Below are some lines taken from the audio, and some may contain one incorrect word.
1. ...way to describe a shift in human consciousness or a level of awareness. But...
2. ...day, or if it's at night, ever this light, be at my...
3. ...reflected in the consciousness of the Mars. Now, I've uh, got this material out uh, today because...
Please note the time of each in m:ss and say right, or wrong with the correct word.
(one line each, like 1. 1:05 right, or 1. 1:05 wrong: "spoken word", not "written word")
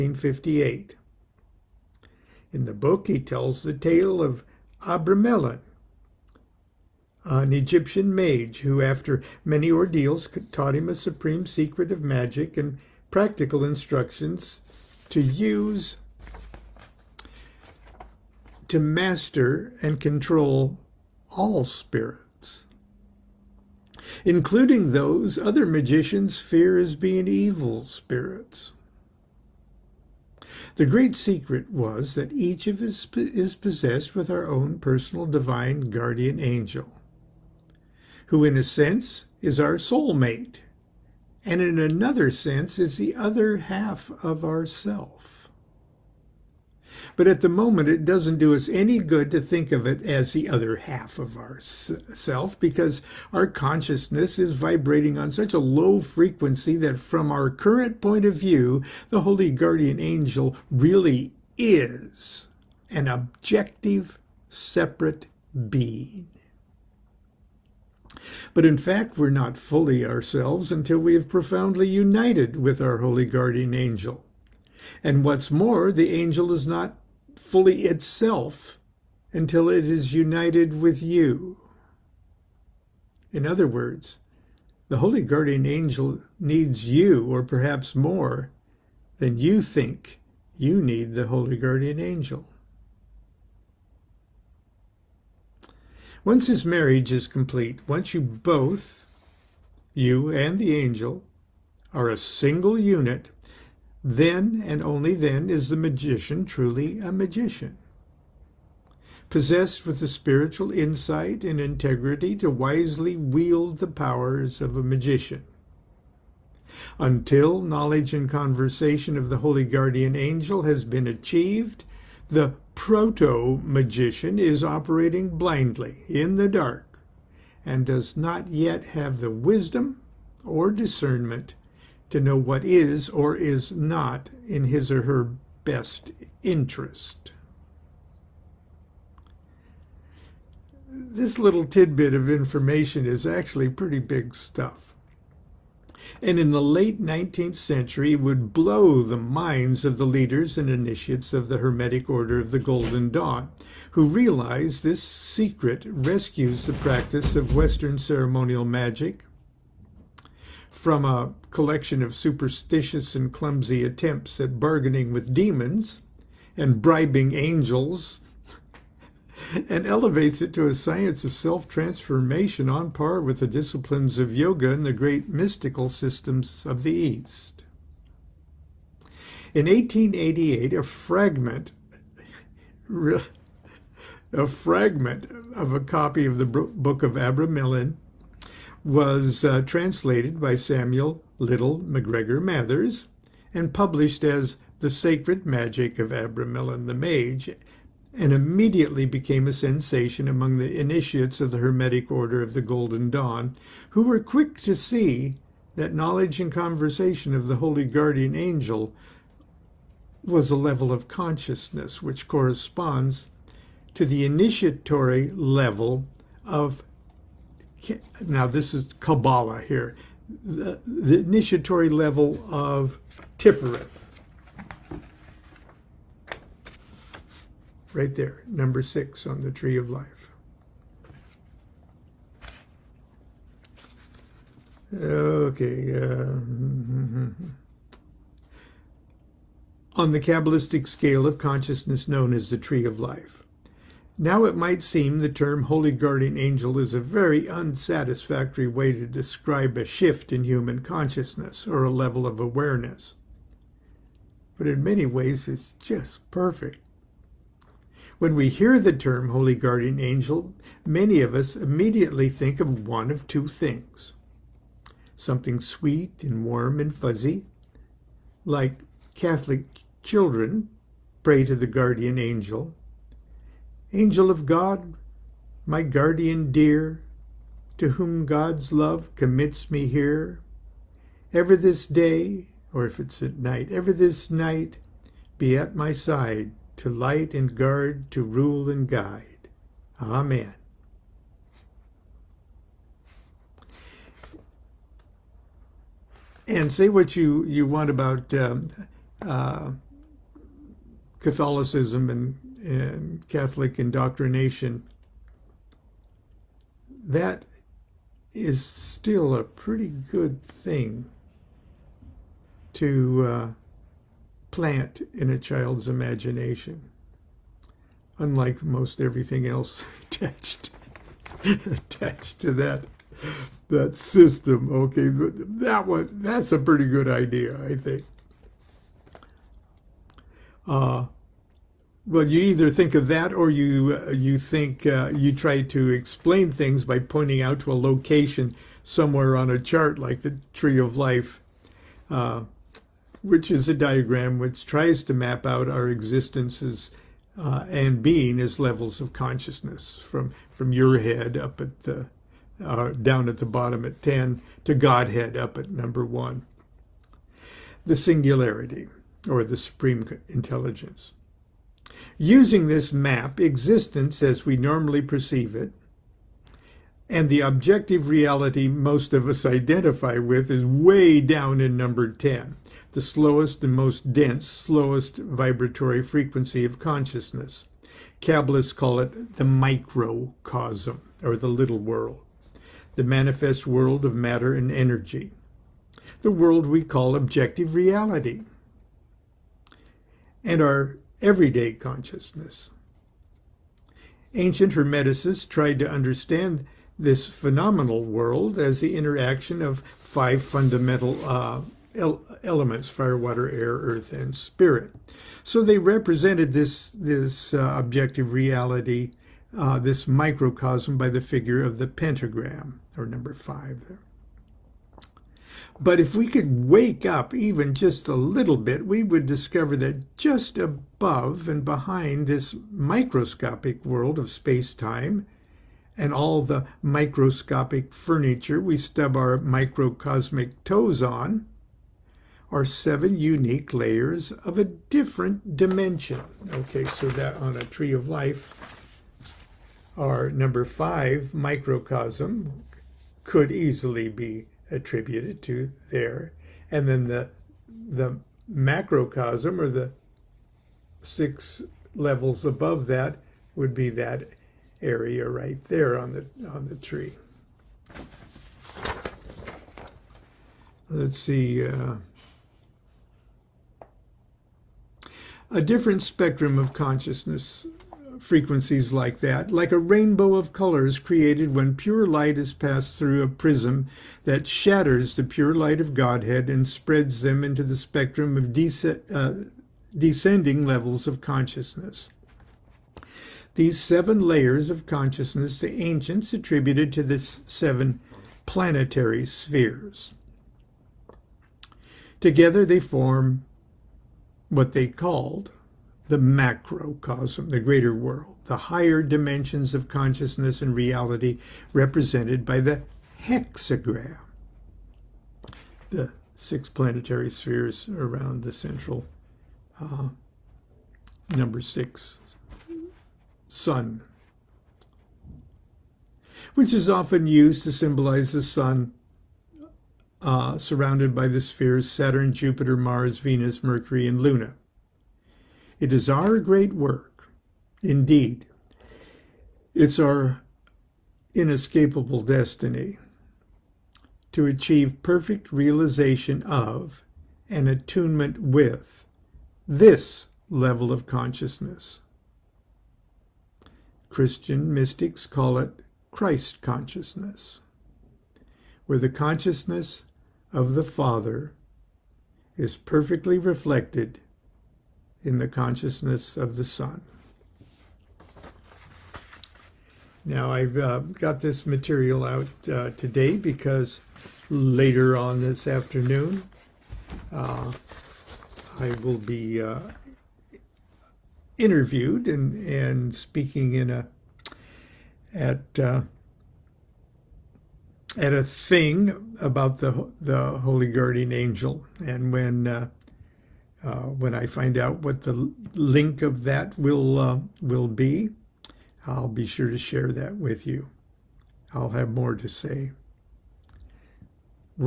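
1. 4:08 right
2. 4:41 wrong: "night", not "light"
3. 9:13 wrong: "Son", not "Mars".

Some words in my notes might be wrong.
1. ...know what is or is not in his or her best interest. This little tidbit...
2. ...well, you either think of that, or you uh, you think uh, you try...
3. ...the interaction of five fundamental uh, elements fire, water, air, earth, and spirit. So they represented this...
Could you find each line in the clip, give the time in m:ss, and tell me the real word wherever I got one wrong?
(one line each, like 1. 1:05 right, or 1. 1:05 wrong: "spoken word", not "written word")
1. 2:12 right
2. 5:32 right
3. 6:38 right.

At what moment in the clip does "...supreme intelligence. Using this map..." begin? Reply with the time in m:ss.
5:59.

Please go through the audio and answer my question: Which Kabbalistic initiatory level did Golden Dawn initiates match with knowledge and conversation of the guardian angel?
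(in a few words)
Tifereth.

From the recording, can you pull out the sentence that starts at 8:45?
It is our great work, indeed.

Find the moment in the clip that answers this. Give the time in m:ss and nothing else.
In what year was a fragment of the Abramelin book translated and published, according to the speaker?
2:59.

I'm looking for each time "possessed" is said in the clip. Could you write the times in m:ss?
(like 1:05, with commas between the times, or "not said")
0:33, 1:49.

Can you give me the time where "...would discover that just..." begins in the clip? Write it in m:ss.
6:59.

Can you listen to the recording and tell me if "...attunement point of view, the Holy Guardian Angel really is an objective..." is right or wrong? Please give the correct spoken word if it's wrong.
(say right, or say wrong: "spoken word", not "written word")
wrong: "current", not "attunement".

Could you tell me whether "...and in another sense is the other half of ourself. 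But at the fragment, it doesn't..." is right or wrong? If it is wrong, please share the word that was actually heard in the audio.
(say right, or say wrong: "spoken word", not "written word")
wrong: "moment", not "fragment".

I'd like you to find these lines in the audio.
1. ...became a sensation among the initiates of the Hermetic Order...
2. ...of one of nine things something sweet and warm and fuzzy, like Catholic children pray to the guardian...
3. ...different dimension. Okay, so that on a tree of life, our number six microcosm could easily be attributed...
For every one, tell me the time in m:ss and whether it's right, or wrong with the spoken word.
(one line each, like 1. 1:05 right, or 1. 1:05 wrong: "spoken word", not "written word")
1. 3:19 right
2. 4:22 wrong: "two", not "nine"
3. 7:14 wrong: "five", not "six".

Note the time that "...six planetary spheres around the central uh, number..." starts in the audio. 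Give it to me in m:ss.
8:26.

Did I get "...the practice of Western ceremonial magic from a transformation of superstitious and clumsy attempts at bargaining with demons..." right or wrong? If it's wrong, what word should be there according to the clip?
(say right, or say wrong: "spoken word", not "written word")
wrong: "collection", not "transformation".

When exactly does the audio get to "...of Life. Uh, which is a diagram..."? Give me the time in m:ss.
5:40.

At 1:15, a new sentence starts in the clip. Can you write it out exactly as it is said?
And what's more, the angel is not fully itself until it is united with you.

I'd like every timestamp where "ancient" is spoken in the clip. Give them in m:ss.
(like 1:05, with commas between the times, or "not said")
6:34, 8:05.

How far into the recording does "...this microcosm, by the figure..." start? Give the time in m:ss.
6:49.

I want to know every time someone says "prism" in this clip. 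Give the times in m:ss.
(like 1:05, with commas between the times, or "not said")
7:53.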